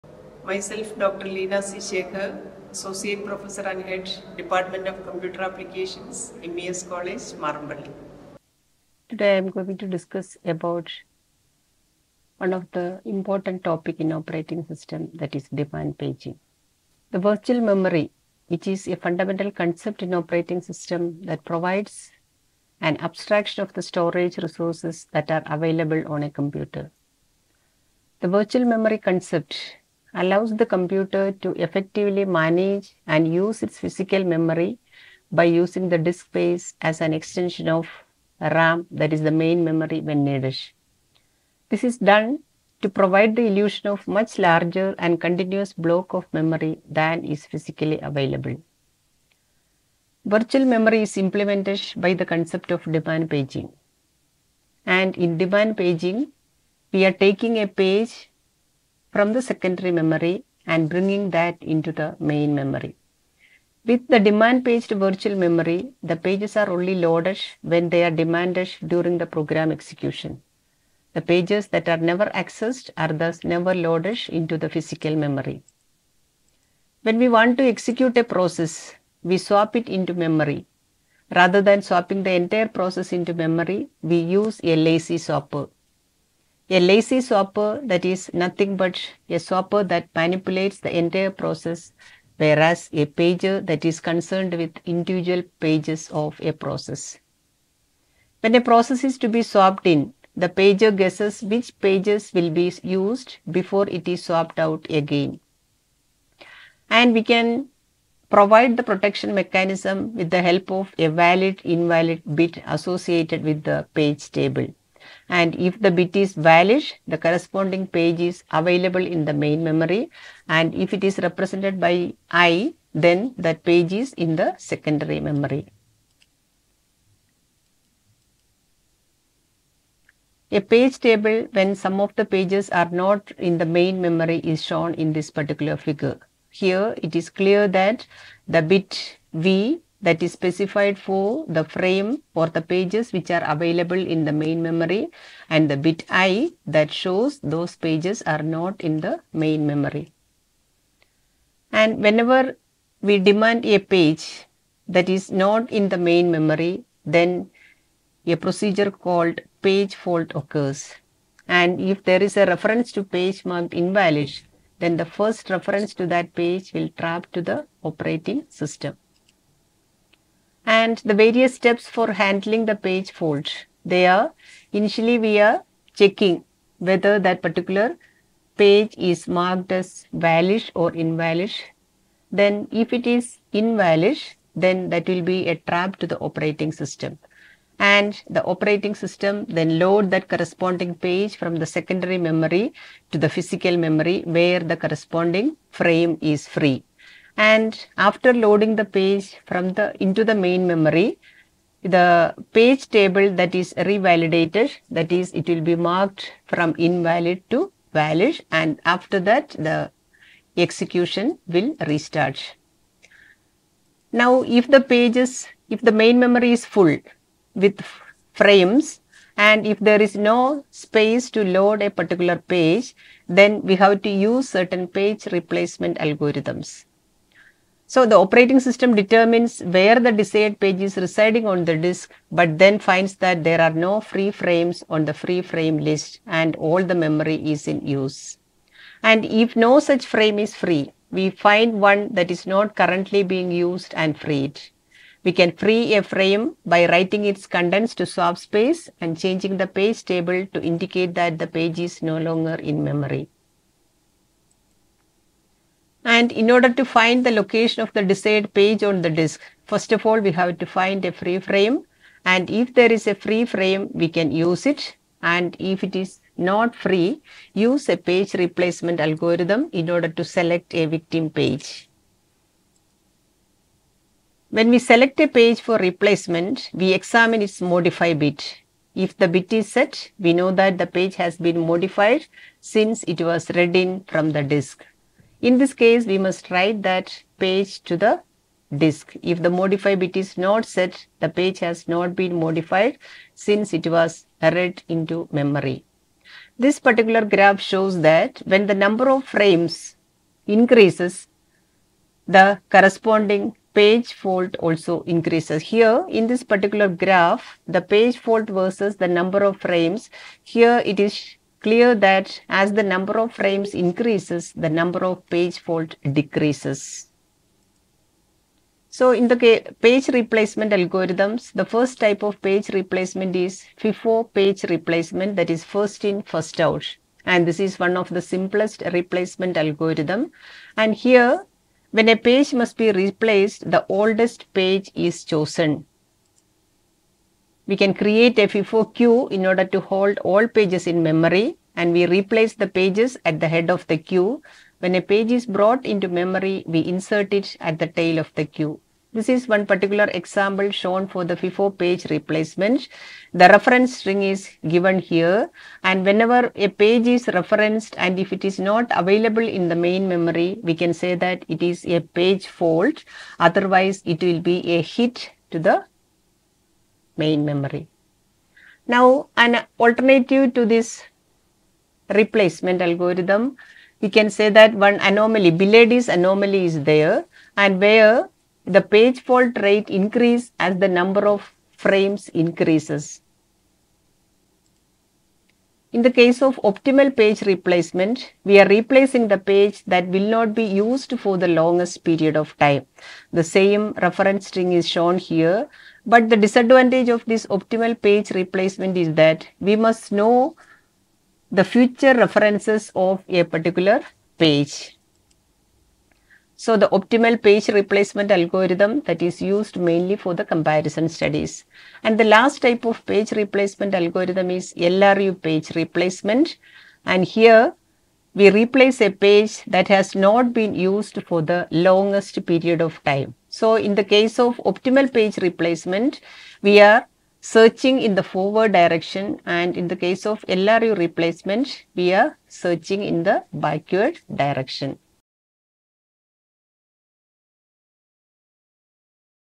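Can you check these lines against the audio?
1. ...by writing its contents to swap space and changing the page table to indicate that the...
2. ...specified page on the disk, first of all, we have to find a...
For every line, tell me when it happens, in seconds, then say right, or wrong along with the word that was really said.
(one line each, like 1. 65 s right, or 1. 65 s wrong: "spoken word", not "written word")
1. 246 s right
2. 258 s wrong: "desired", not "specified".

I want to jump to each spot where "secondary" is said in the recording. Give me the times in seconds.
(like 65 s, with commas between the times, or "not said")
59 s, 124 s, 191 s.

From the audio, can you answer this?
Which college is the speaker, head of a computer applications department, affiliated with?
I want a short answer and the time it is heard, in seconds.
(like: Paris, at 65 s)
MES College, Marampally, at 6 s.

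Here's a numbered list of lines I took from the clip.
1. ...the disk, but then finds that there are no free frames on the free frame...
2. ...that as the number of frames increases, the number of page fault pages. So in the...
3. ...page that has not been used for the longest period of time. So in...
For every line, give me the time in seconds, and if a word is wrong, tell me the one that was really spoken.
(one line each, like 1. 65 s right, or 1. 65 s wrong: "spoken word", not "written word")
1. 231 s right
2. 311 s wrong: "decreases", not "pages"
3. 419 s right.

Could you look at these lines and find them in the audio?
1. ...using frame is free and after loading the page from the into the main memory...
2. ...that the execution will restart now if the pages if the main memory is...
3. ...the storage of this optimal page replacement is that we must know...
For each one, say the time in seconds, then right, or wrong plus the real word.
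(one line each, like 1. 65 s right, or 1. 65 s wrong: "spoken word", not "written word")
1. 194 s wrong: "corresponding", not "using"
2. 209 s right
3. 396 s wrong: "disadvantage", not "storage".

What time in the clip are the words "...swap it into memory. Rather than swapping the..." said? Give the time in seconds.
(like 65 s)
79 s.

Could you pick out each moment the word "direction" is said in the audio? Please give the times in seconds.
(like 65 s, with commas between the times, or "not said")
428 s, 434 s.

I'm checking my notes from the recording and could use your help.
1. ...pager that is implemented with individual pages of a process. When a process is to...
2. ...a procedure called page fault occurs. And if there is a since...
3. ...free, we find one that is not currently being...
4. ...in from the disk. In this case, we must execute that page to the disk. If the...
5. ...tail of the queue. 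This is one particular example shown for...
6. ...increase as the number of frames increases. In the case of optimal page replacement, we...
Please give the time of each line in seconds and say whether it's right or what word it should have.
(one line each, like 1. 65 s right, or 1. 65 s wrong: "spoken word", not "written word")
1. 93 s wrong: "concerned", not "implemented"
2. 158 s wrong: "reference", not "since"
3. 240 s right
4. 283 s wrong: "write", not "execute"
5. 347 s right
6. 379 s right.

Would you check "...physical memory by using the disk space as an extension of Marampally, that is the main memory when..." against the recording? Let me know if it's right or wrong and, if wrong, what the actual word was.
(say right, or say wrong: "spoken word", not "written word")
wrong: "RAM", not "Marampally".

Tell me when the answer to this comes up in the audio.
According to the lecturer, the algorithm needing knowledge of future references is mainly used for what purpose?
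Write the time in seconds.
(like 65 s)
410 s.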